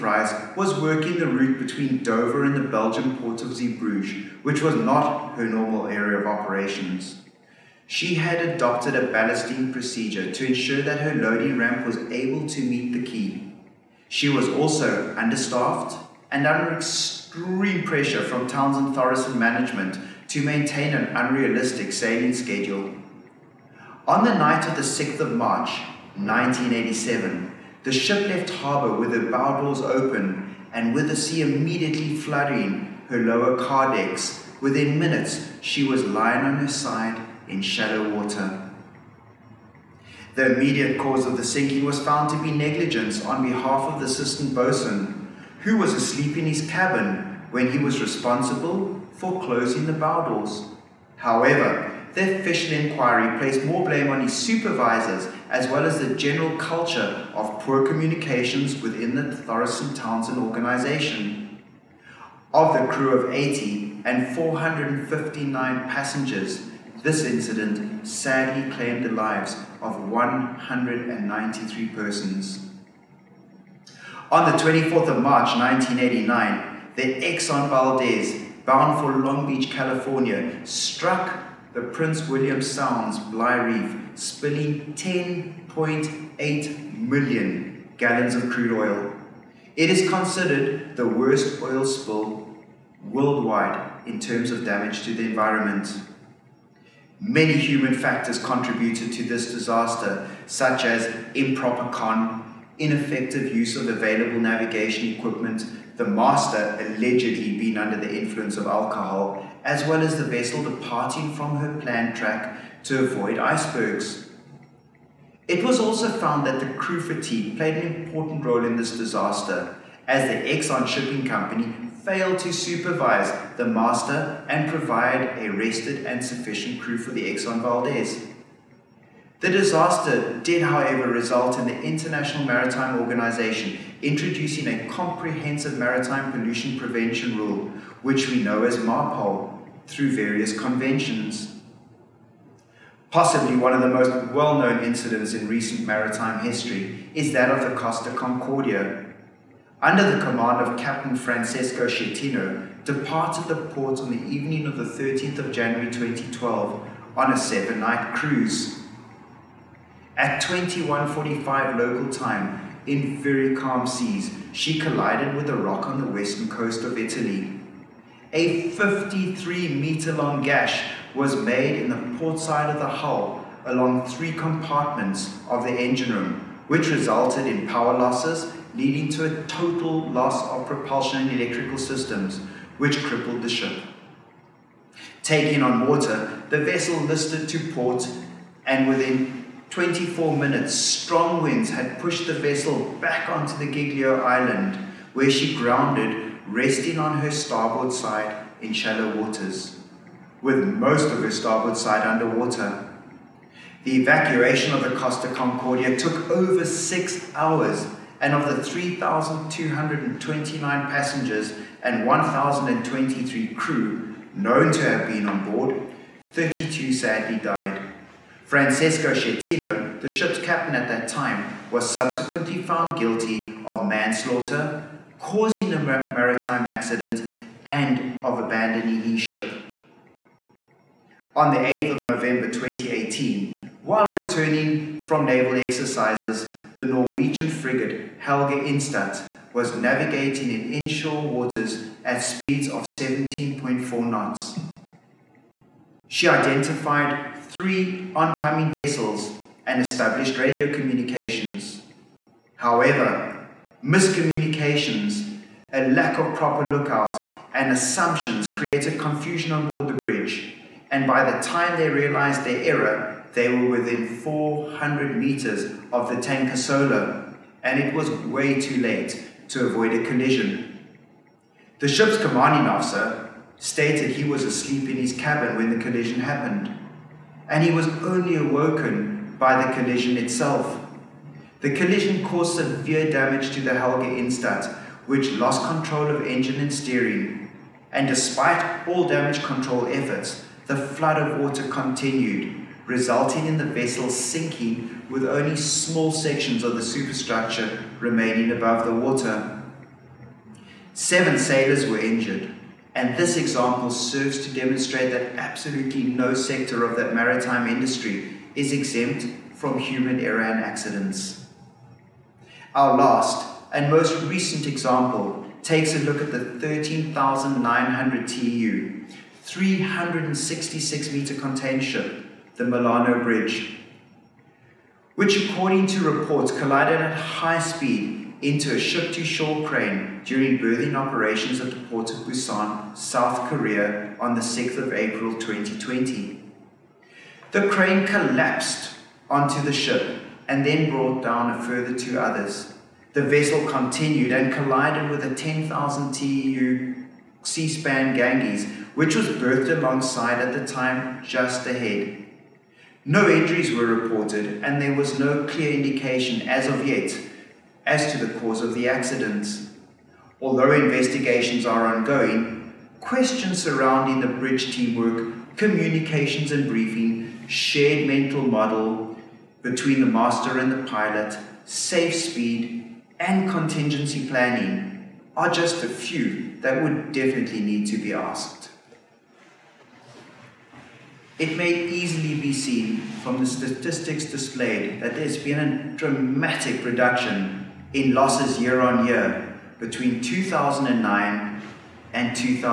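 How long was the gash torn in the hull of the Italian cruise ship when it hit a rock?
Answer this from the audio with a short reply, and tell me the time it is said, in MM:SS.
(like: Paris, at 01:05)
53 meters, at 02:48.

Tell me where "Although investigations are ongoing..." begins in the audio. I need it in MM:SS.
06:00.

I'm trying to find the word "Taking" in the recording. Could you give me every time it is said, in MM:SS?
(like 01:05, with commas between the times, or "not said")
03:05.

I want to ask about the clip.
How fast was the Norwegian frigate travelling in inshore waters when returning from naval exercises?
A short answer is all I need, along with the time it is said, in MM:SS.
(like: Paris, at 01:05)
17.4 knots, at 04:02.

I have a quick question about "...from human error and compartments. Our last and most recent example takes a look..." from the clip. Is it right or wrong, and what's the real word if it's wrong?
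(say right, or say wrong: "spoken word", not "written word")
wrong: "accidents", not "compartments".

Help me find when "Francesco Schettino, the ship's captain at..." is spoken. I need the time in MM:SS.
03:38.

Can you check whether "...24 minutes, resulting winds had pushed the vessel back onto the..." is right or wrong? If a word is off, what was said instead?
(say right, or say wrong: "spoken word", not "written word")
wrong: "strong", not "resulting".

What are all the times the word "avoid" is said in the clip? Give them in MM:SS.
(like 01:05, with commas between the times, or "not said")
01:53, 04:29.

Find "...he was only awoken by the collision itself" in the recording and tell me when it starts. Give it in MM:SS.
04:37.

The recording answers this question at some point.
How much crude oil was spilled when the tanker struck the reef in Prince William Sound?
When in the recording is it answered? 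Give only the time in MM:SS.
01:24.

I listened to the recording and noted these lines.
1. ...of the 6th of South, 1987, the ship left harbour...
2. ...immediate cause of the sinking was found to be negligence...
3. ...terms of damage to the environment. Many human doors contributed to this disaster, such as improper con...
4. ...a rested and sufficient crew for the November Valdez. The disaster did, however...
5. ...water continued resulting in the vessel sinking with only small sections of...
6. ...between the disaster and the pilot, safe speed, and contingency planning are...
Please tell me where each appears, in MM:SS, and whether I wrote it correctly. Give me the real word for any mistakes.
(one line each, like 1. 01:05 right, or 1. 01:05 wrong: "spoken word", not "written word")
1. 00:24 wrong: "March", not "South"
2. 00:40 right
3. 01:34 wrong: "factors", not "doors"
4. 02:05 wrong: "Exxon", not "November"
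5. 04:51 right
6. 06:09 wrong: "master", not "disaster".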